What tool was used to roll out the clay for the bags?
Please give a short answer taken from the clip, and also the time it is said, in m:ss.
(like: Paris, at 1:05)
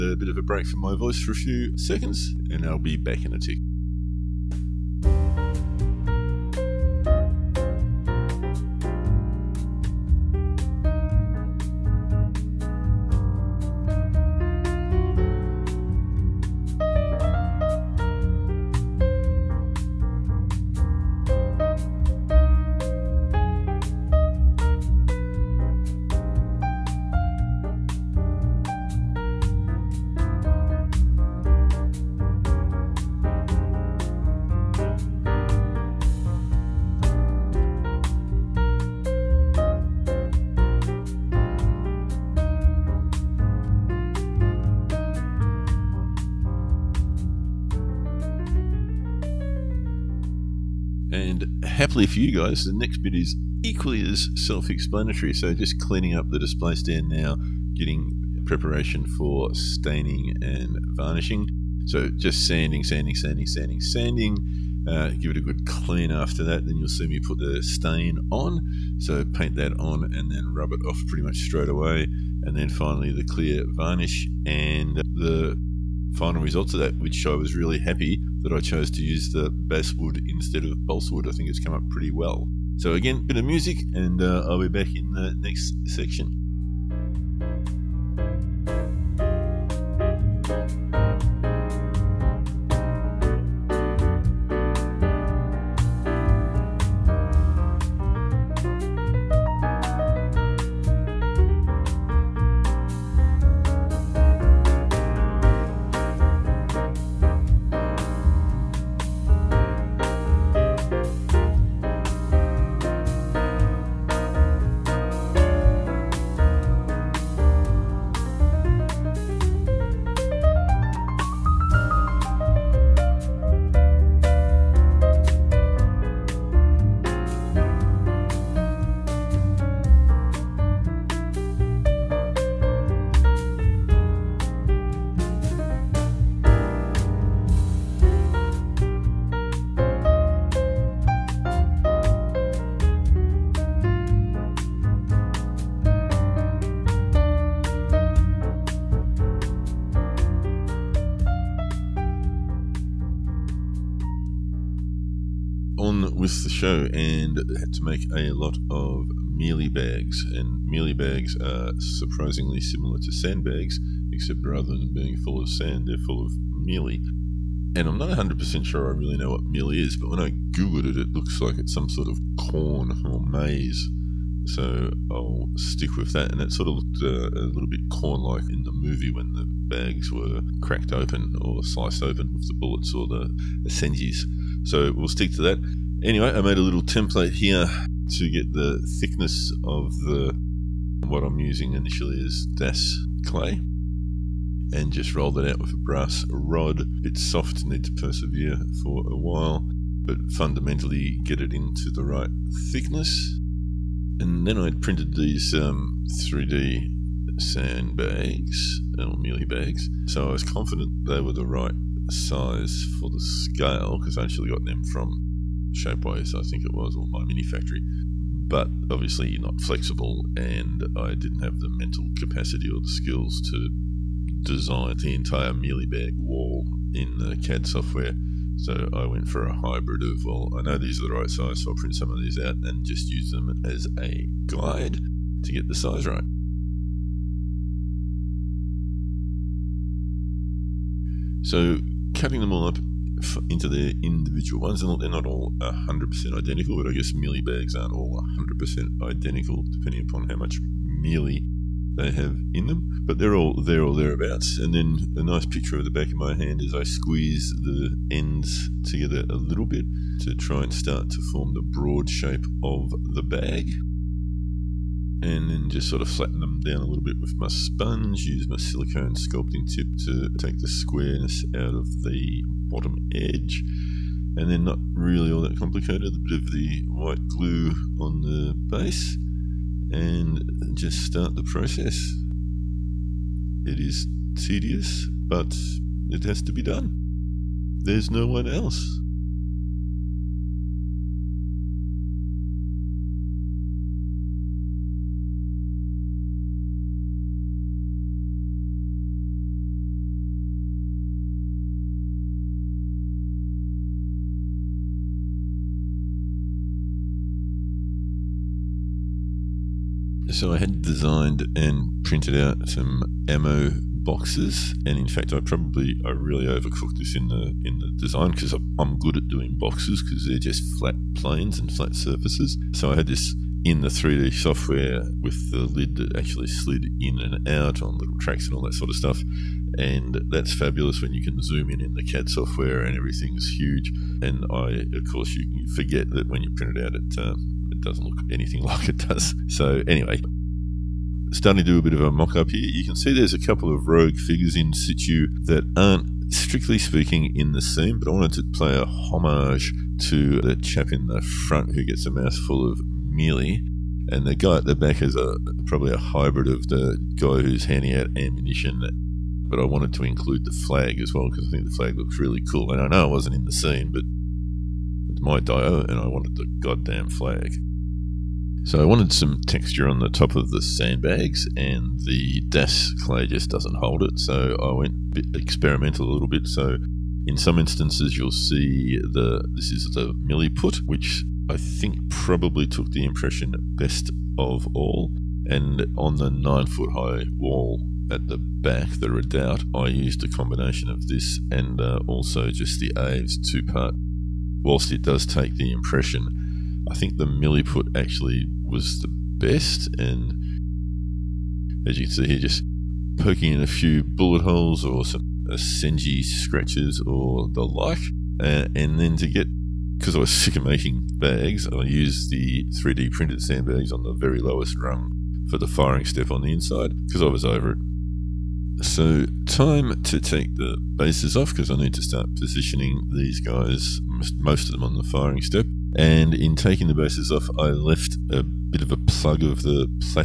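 brass rod, at 3:15.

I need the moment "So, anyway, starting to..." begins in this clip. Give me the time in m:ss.
5:39.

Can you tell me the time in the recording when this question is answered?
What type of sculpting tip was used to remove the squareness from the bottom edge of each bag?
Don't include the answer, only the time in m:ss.
4:28.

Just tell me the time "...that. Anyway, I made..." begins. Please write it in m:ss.
3:05.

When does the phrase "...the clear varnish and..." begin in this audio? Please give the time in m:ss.
1:13.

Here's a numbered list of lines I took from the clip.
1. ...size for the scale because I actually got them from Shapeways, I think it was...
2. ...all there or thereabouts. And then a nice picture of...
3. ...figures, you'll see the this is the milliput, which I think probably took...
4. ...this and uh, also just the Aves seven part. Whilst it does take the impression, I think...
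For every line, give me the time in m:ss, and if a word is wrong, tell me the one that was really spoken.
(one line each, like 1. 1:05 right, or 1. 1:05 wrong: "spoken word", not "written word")
1. 3:32 right
2. 4:13 right
3. 6:17 wrong: "instances", not "figures"
4. 6:31 wrong: "two", not "seven".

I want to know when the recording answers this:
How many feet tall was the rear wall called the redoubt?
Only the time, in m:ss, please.
6:26.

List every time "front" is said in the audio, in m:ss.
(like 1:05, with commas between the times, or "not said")
5:51.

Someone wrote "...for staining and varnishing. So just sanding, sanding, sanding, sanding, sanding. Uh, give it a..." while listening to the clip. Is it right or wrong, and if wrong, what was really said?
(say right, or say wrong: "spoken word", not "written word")
right.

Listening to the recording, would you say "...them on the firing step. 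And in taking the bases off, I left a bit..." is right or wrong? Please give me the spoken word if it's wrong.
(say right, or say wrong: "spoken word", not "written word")
right.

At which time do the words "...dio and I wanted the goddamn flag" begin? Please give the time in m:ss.
6:05.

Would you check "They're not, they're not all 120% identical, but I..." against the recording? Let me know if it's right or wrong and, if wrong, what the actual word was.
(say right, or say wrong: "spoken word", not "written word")
wrong: "100", not "120".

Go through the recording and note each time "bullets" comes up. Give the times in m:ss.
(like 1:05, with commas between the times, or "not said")
3:02, 6:44.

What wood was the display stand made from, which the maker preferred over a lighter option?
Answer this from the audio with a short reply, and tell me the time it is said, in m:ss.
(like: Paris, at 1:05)
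basswood, at 1:19.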